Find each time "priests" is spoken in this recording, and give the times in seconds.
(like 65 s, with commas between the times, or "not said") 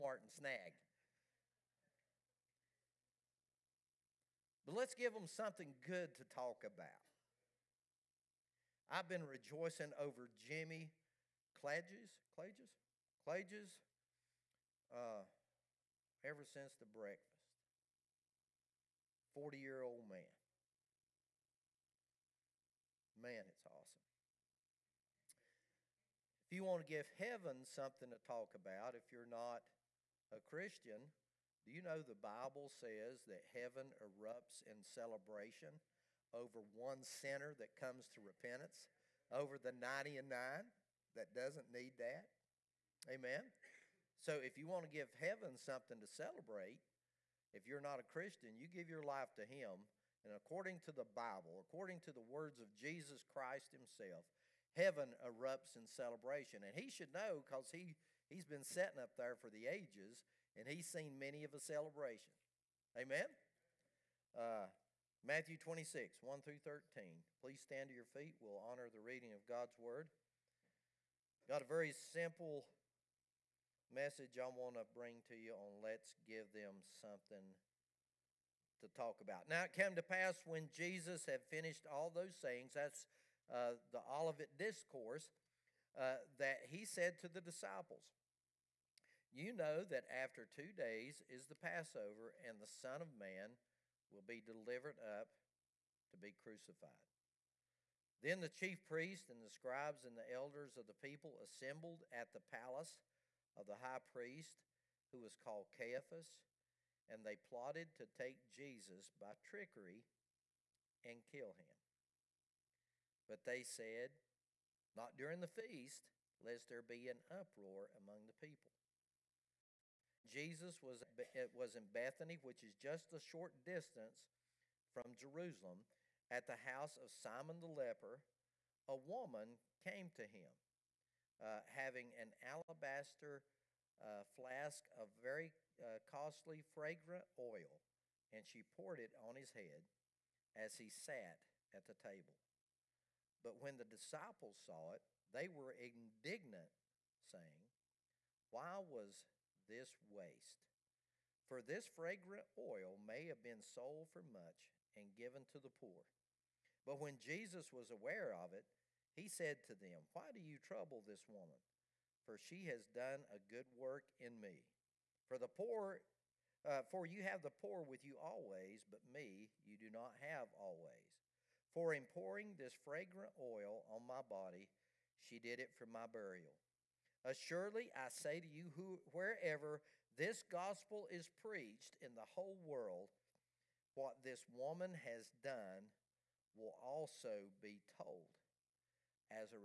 98 s, 103 s.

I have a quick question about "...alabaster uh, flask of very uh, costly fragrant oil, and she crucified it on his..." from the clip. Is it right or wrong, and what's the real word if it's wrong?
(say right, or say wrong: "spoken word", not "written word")
wrong: "poured", not "crucified".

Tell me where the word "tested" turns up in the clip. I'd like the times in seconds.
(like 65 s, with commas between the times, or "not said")
not said.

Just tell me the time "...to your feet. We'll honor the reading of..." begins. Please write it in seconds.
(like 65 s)
67 s.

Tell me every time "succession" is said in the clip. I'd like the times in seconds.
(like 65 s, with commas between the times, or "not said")
not said.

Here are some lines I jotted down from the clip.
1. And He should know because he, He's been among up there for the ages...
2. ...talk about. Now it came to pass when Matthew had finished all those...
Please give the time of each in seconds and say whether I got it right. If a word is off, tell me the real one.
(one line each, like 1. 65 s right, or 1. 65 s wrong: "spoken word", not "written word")
1. 56 s wrong: "sitting", not "among"
2. 78 s wrong: "Jesus", not "Matthew".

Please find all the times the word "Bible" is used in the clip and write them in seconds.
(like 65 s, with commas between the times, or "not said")
32 s, 51 s.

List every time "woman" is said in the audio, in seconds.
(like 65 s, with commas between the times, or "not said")
128 s, 161 s, 184 s.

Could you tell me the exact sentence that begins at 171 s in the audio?
For in pouring this fragrant oil on my body, she did it for my burial.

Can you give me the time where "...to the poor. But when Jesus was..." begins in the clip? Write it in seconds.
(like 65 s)
155 s.